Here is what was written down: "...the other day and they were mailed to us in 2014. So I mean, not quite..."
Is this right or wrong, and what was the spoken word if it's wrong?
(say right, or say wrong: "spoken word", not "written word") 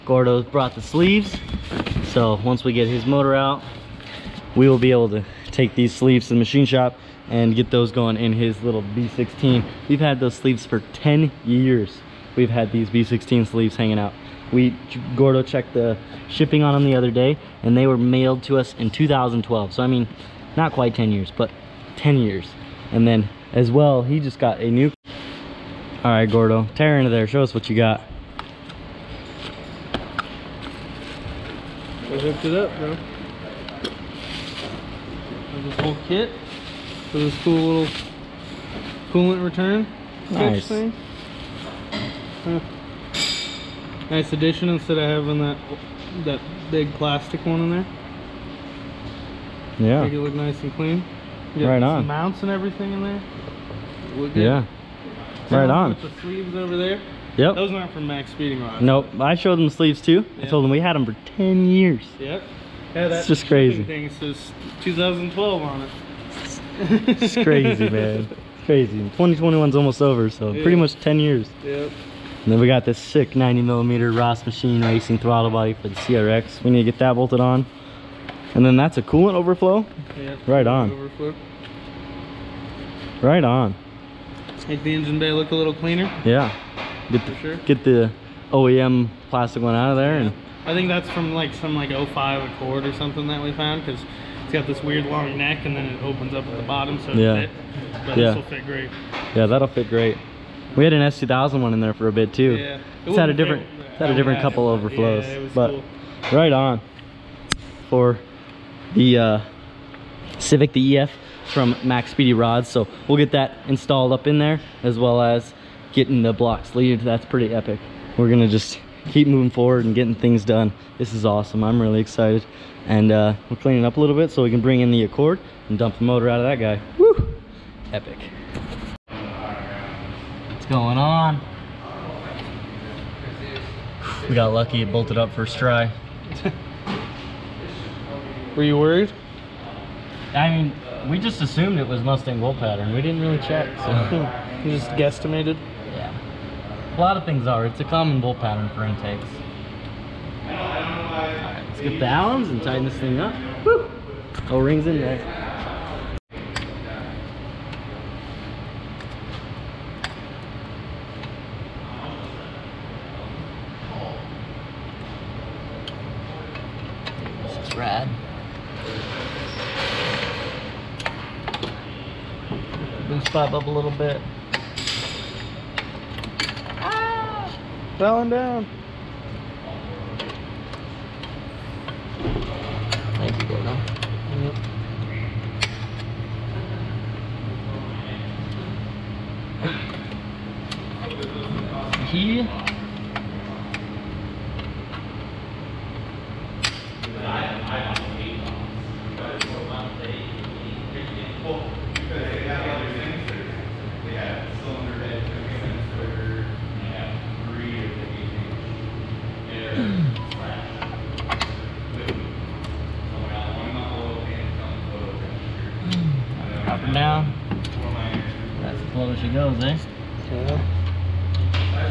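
wrong: "2012", not "2014".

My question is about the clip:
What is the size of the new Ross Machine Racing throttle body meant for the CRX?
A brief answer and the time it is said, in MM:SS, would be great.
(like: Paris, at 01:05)
90 millimeter, at 01:13.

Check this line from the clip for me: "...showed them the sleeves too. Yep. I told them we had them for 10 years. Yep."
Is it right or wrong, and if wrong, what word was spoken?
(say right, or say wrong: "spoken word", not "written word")
right.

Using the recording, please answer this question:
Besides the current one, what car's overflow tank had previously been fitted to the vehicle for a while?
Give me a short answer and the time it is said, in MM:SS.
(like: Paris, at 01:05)
S2000, at 01:41.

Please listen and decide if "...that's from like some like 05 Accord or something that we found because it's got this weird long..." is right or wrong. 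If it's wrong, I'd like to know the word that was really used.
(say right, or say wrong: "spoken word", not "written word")
right.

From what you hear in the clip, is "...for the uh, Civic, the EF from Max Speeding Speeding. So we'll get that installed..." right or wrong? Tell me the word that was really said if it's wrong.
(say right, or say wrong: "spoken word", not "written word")
wrong: "Rods", not "Speeding".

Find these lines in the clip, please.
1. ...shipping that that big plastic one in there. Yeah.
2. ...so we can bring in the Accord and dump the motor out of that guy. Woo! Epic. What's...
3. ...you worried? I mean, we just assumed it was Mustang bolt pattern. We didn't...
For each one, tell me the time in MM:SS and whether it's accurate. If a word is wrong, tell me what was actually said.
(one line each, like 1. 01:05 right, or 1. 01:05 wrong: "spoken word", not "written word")
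1. 00:45 wrong: "having", not "shipping"
2. 02:04 right
3. 02:18 right.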